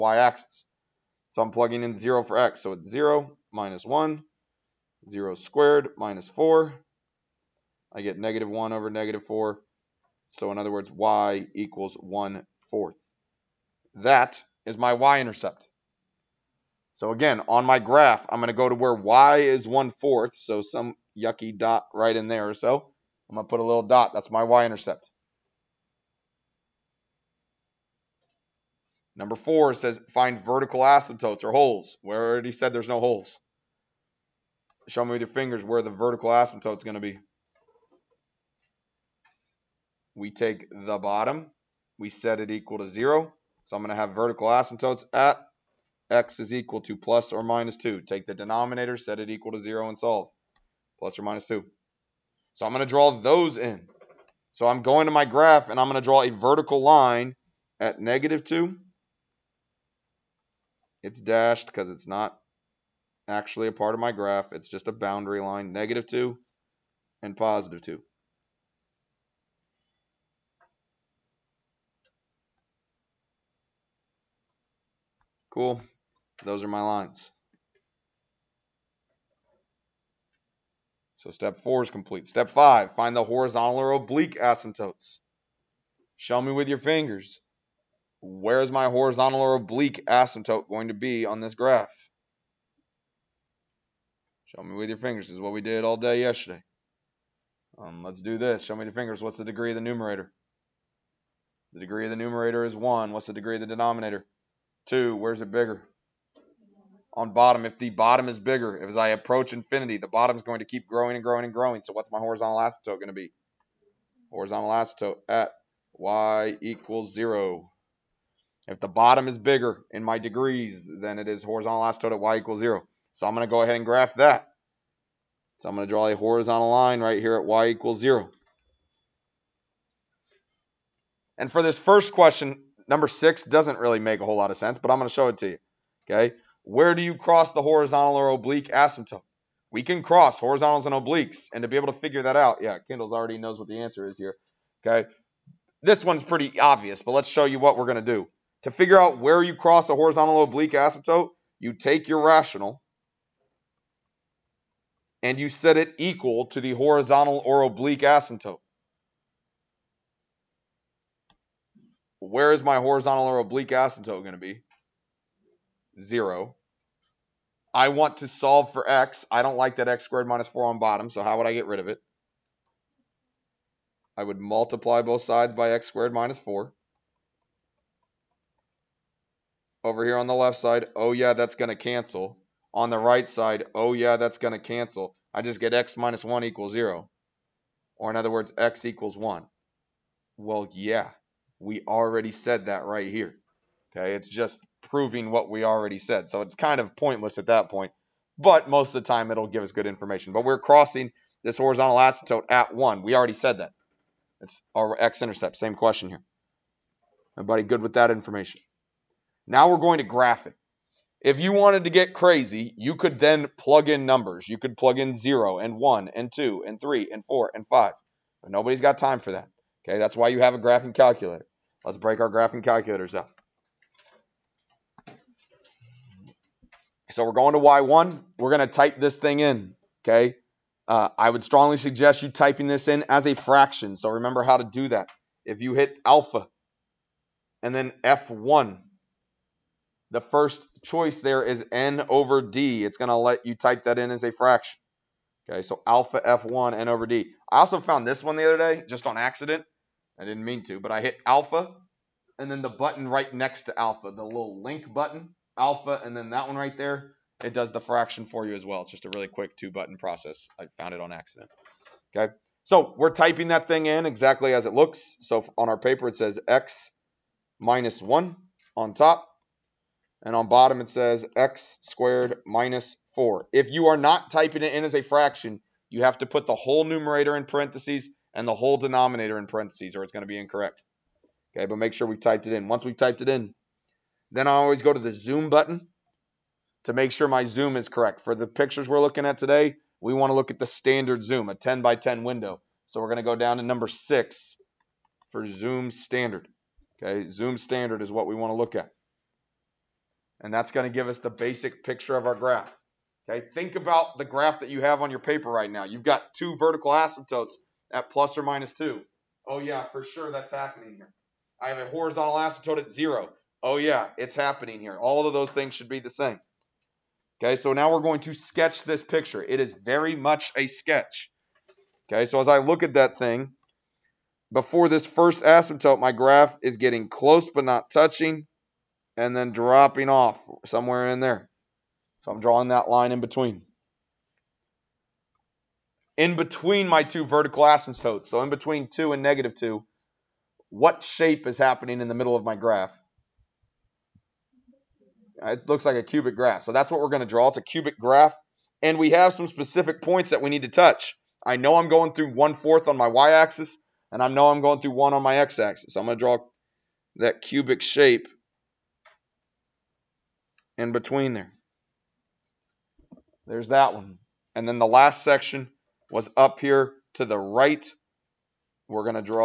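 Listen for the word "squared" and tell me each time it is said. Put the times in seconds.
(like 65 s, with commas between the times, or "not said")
5 s, 170 s, 175 s, 271 s.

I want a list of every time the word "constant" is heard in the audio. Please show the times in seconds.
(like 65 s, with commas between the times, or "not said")
not said.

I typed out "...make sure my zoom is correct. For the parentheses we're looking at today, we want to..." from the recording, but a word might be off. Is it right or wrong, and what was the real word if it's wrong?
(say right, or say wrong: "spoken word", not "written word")
wrong: "pictures", not "parentheses".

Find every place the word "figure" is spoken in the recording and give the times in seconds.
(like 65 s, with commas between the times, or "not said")
141 s, 148 s.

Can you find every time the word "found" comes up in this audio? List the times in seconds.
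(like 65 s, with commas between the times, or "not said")
247 s, 260 s.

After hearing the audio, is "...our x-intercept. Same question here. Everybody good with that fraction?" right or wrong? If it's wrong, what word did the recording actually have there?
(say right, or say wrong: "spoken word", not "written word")
wrong: "information", not "fraction".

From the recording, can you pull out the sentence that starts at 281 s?
Okay, but make sure we typed it in.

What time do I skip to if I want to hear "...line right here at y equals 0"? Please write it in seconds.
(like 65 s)
126 s.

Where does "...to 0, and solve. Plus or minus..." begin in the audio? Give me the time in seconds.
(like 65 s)
49 s.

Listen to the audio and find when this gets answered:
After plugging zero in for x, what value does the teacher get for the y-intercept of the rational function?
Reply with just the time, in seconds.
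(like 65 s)
10 s.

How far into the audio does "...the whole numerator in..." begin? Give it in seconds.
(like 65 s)
276 s.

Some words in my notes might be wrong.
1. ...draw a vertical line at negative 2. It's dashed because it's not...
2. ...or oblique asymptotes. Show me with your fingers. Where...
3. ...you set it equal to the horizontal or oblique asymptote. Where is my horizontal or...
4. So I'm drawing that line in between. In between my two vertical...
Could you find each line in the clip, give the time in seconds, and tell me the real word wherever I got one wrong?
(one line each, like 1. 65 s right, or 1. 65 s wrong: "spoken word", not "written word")
1. 56 s right
2. 83 s right
3. 155 s right
4. 332 s right.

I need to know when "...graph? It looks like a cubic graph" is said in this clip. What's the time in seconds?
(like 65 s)
342 s.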